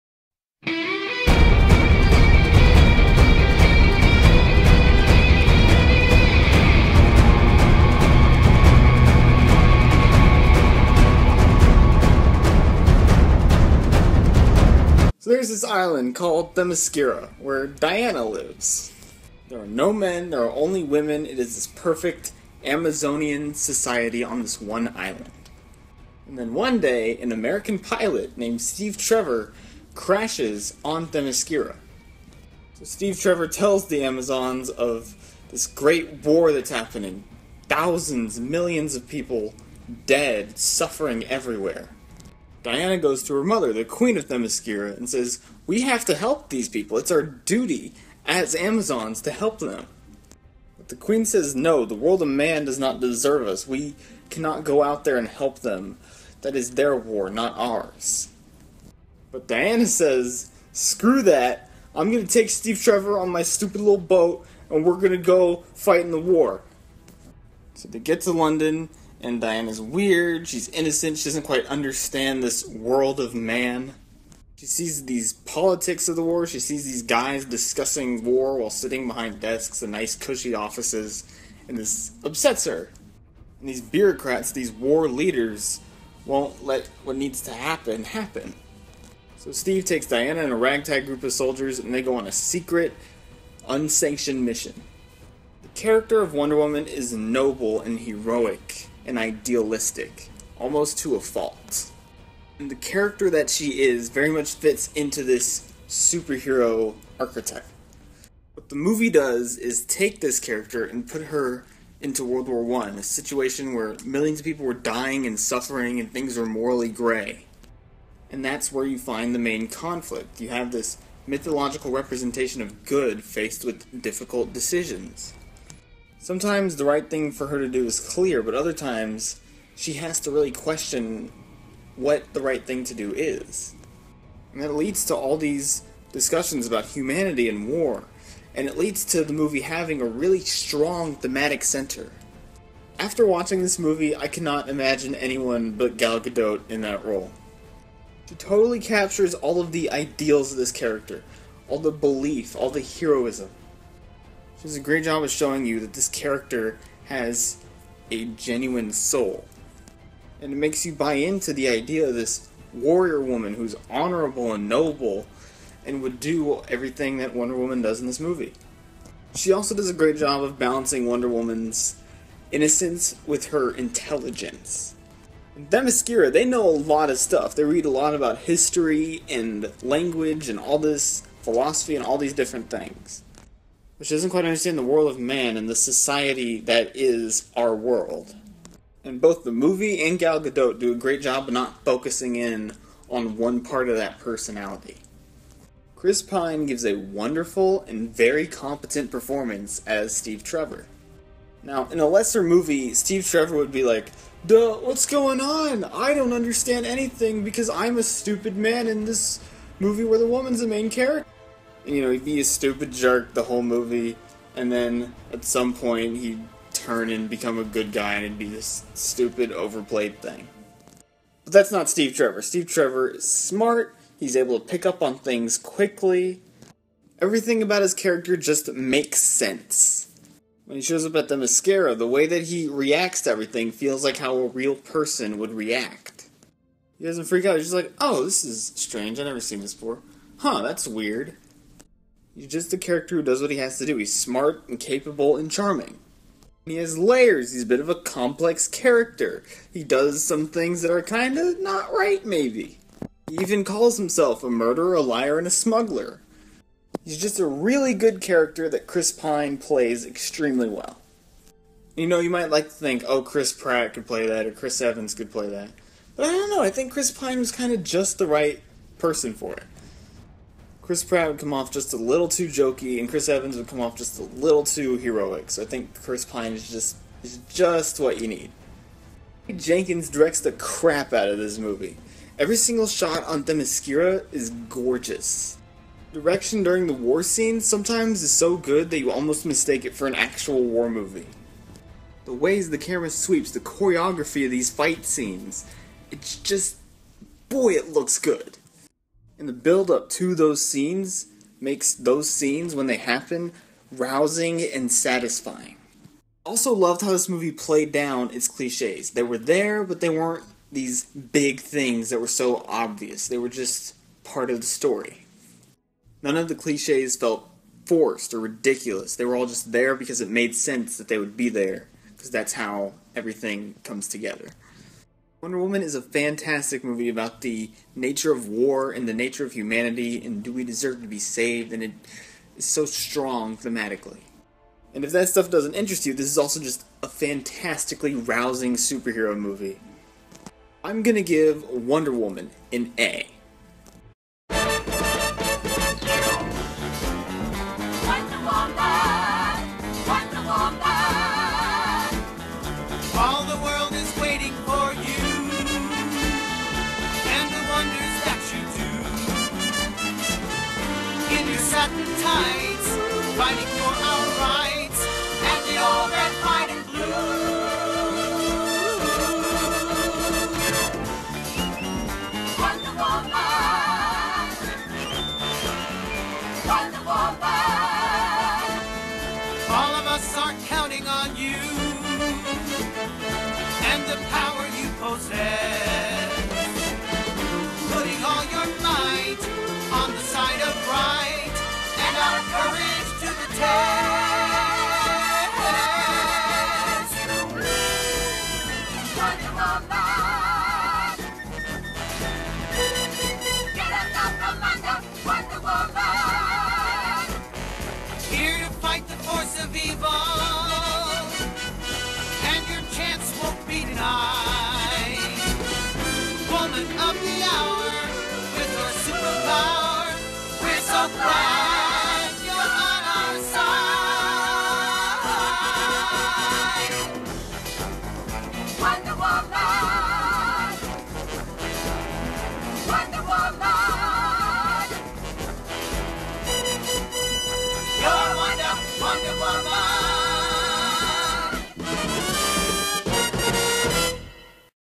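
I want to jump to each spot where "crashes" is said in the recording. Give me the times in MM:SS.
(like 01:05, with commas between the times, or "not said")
00:29.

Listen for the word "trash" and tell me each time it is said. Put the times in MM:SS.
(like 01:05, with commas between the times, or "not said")
not said.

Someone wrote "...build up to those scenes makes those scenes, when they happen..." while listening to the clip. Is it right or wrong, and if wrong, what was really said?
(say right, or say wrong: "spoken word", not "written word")
right.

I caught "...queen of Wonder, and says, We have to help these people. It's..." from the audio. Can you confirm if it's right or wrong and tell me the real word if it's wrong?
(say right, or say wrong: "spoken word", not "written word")
wrong: "Themyscira", not "Wonder".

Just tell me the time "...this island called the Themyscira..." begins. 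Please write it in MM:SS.
00:15.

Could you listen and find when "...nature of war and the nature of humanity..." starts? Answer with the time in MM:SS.
05:27.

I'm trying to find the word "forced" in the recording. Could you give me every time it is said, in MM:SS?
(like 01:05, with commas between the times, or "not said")
05:17.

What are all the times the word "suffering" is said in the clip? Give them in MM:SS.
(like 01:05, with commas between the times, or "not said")
00:40, 01:55.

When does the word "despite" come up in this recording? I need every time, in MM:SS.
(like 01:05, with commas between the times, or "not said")
not said.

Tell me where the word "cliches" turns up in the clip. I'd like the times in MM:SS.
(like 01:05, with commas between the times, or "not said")
05:08, 05:16.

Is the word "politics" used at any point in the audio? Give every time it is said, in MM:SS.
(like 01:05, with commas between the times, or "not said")
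01:15.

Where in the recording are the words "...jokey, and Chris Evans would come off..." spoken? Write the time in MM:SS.
04:32.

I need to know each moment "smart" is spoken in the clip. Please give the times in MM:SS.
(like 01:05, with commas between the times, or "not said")
03:43, 04:04.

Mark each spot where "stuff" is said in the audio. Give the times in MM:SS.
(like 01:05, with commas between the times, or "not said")
02:57, 05:35.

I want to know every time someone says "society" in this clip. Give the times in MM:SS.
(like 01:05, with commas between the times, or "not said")
00:23, 03:05.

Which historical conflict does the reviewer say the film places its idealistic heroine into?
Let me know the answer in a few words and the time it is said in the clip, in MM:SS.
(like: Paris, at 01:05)
World War One, at 01:52.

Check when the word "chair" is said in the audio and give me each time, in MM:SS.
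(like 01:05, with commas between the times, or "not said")
not said.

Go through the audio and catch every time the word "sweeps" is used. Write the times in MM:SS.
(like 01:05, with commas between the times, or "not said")
04:53.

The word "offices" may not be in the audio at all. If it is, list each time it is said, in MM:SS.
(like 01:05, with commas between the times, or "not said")
01:20.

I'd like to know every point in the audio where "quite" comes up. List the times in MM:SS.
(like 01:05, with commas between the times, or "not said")
01:11, 03:04.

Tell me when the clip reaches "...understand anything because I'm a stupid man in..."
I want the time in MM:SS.
03:26.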